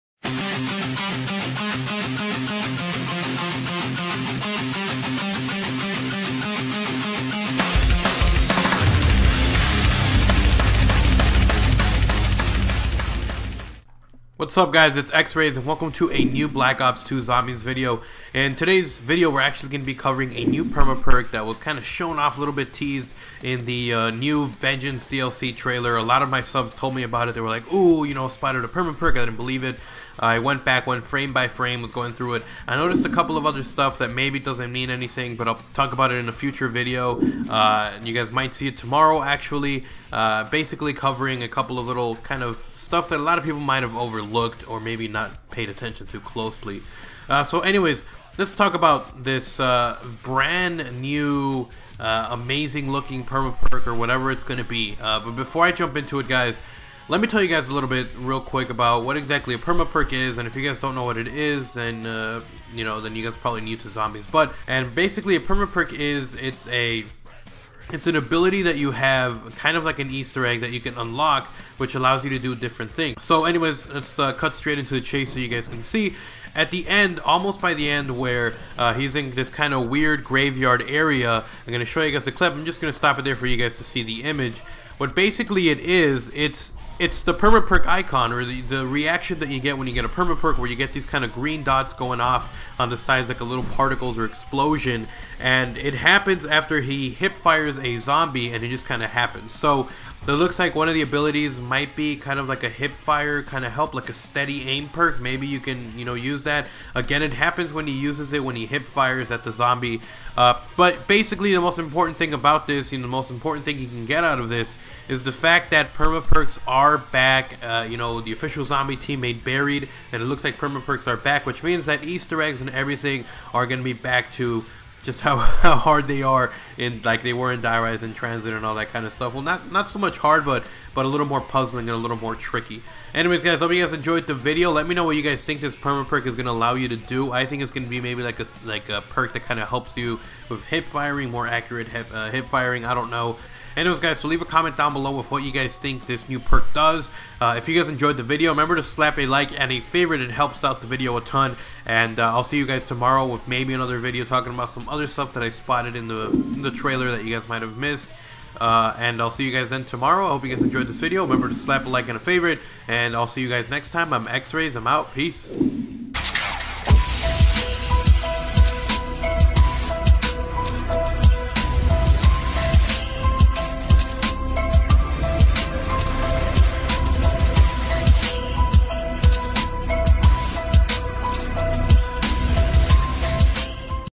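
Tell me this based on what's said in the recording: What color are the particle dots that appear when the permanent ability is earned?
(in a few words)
Green.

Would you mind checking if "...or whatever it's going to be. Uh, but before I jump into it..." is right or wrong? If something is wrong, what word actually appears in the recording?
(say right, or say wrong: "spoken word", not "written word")
right.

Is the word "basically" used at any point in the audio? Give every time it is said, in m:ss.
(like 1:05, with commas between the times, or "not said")
0:40, 1:04, 1:25, 1:51.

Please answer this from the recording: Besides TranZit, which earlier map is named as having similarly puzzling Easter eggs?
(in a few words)
Die Rise.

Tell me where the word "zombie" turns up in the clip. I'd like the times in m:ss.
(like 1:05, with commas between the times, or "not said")
0:17, 1:03, 1:37, 1:49, 1:58.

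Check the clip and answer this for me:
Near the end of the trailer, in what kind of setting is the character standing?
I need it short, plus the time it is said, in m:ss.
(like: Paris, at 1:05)
Graveyard, at 1:20.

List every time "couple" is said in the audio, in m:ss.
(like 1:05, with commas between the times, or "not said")
0:33, 0:41.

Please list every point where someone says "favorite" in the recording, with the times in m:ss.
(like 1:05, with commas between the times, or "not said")
2:29, 2:42.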